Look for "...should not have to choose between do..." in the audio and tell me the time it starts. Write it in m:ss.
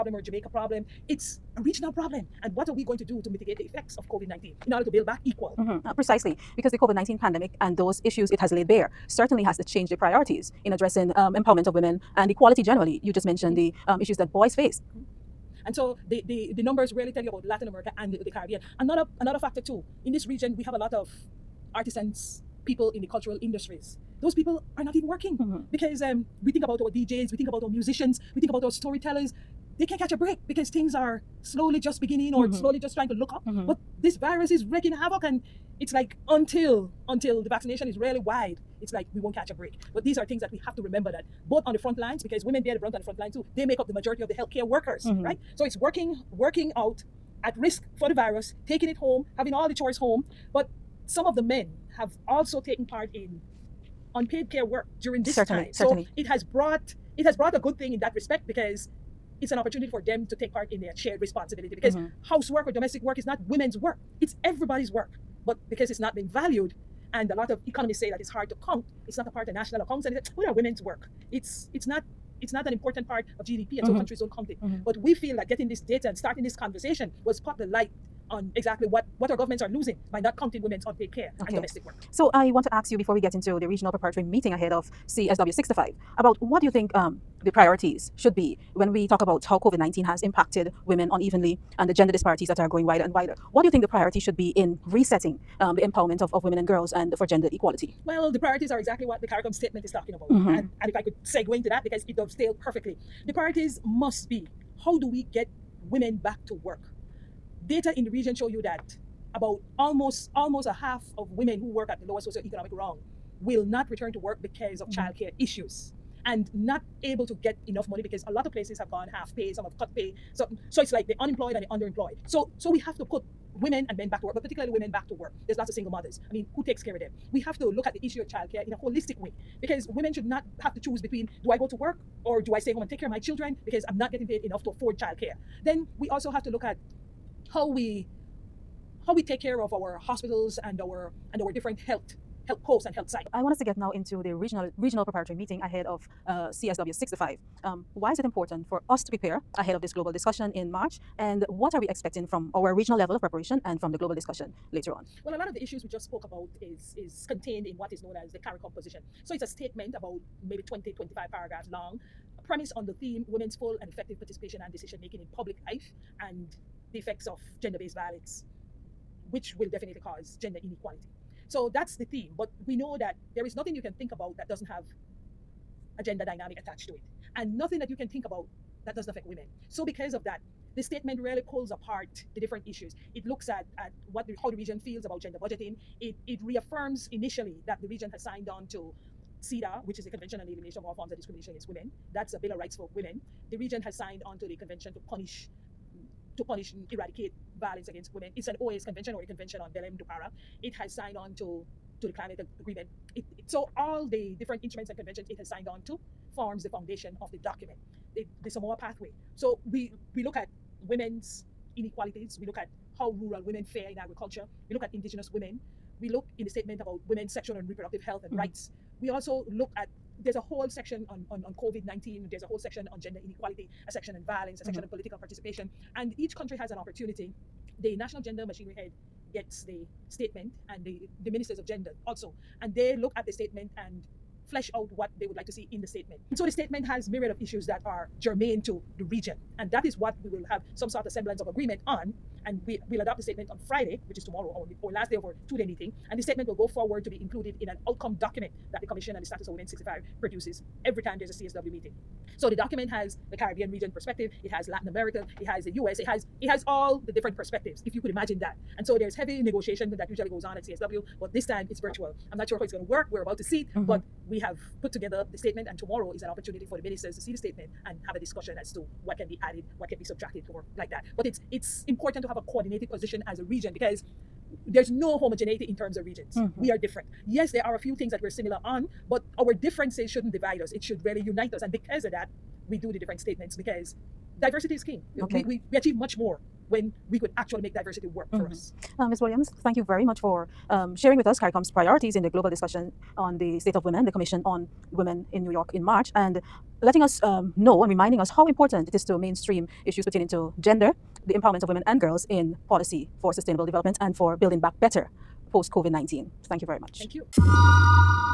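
2:10.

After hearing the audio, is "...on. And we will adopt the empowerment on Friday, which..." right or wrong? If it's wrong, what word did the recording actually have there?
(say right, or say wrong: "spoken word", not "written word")
wrong: "statement", not "empowerment".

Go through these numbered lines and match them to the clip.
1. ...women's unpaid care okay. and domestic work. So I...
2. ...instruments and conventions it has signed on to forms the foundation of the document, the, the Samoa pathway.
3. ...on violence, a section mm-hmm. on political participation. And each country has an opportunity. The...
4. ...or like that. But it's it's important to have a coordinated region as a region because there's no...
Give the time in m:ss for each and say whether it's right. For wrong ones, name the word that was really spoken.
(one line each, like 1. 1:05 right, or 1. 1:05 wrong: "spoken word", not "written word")
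1. 1:20 right
2. 3:24 right
3. 3:44 right
4. 4:30 wrong: "position", not "region".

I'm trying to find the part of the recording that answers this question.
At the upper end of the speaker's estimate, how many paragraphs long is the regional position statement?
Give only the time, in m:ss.
2:40.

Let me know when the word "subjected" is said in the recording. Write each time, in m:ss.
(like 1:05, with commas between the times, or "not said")
not said.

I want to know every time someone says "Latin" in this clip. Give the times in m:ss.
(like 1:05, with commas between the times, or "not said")
0:17, 4:14.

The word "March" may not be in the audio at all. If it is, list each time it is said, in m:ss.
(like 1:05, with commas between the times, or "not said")
2:30, 4:55.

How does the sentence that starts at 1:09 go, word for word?
It's not a part of national accounts, and It's what are women's work?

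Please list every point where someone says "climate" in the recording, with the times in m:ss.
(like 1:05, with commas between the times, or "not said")
3:22.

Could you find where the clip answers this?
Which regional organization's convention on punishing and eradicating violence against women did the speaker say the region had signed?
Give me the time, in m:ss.
3:18.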